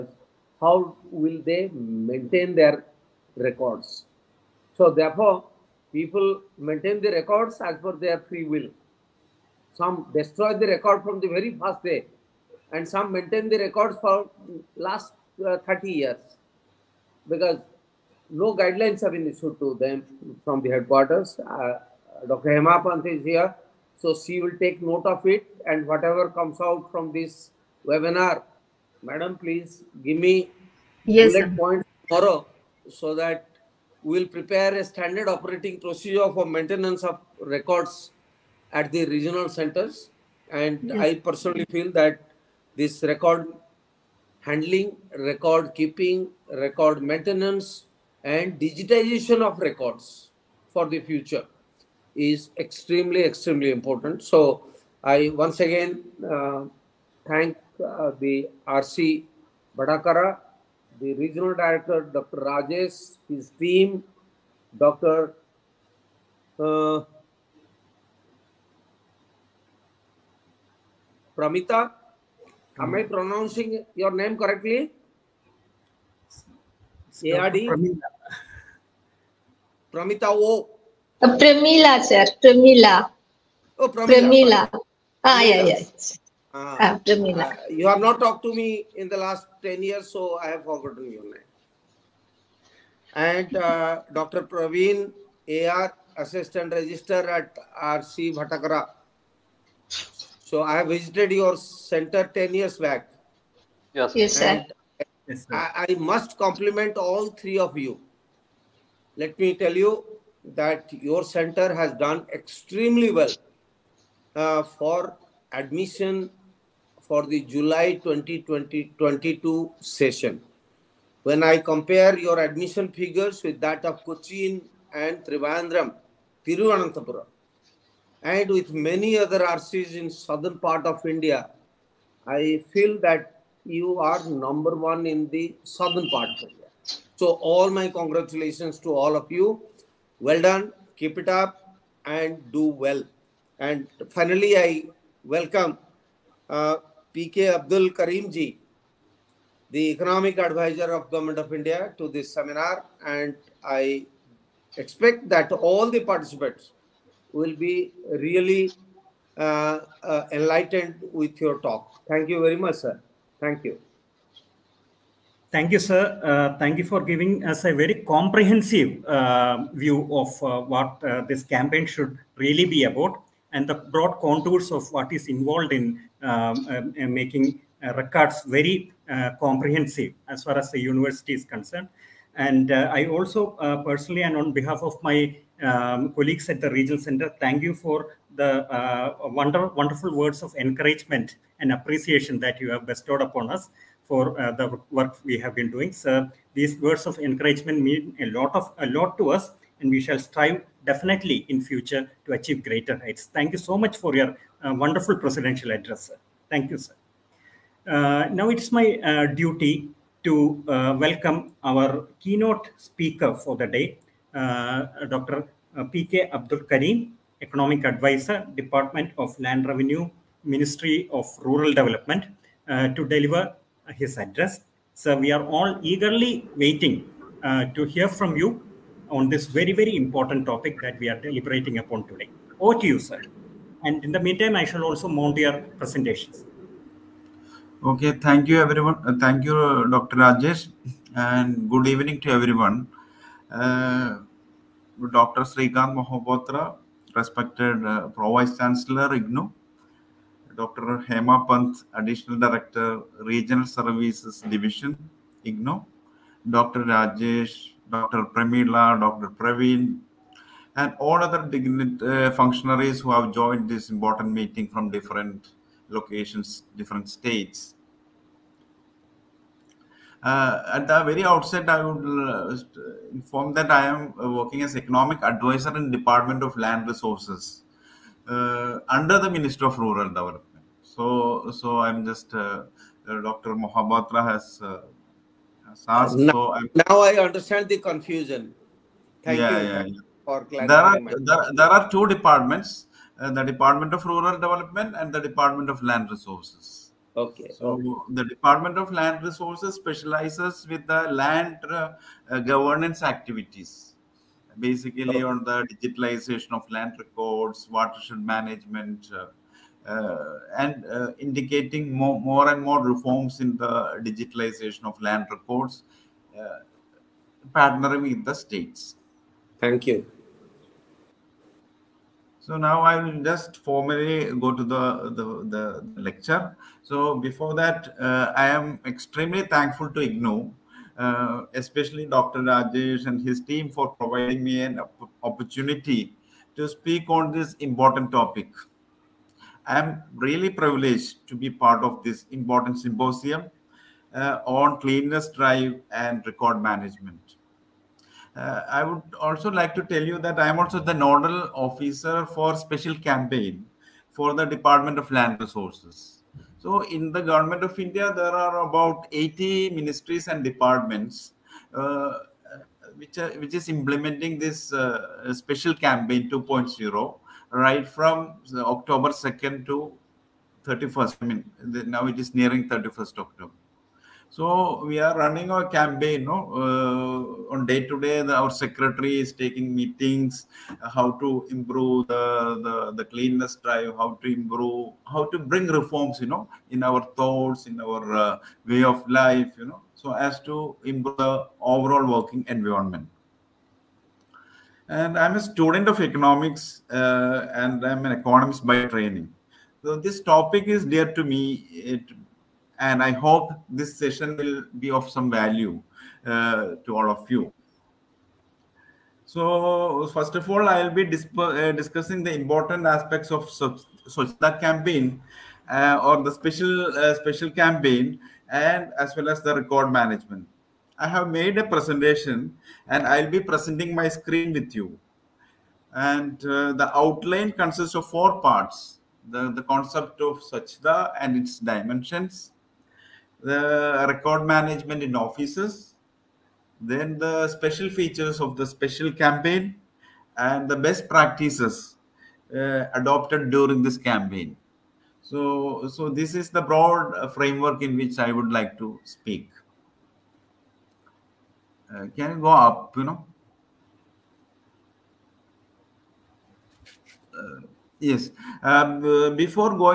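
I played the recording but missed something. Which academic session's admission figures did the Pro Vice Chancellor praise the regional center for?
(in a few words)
July 2022.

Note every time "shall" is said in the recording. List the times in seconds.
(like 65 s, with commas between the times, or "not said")
200 s, 234 s.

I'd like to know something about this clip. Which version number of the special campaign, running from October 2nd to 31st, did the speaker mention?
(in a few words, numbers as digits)
2.0.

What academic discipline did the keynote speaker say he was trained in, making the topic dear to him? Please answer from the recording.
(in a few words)
Economics.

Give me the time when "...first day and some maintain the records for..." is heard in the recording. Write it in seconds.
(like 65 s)
11 s.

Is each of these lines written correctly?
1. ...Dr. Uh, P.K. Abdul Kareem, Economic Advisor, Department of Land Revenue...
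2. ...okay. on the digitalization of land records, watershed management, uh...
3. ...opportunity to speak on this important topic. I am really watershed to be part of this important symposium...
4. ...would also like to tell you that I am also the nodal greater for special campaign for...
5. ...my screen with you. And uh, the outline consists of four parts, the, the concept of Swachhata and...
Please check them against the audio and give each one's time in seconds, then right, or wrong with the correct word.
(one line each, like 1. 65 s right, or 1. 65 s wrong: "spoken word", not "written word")
1. 215 s right
2. 305 s right
3. 335 s wrong: "privileged", not "watershed"
4. 348 s wrong: "officer", not "greater"
5. 423 s right.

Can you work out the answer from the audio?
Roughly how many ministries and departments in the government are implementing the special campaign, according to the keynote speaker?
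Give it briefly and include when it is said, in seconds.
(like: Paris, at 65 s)
80, at 359 s.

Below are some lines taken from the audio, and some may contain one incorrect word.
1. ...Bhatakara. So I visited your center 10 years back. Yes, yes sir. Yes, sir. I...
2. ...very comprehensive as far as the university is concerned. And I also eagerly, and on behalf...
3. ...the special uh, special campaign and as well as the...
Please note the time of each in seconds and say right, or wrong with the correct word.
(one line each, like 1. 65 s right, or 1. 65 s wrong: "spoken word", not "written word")
1. 98 s right
2. 178 s wrong: "personally", not "eagerly"
3. 416 s right.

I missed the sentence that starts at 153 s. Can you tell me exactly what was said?
And I expect that all the participants will be really uh, uh, enlightened with your talk.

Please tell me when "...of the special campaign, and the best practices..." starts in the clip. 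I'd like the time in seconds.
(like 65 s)
438 s.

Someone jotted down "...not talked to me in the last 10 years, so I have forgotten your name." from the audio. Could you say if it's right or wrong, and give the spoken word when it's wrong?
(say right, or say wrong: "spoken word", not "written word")
right.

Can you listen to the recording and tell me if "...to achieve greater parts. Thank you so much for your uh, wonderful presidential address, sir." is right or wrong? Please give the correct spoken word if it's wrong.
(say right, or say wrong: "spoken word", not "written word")
wrong: "heights", not "parts".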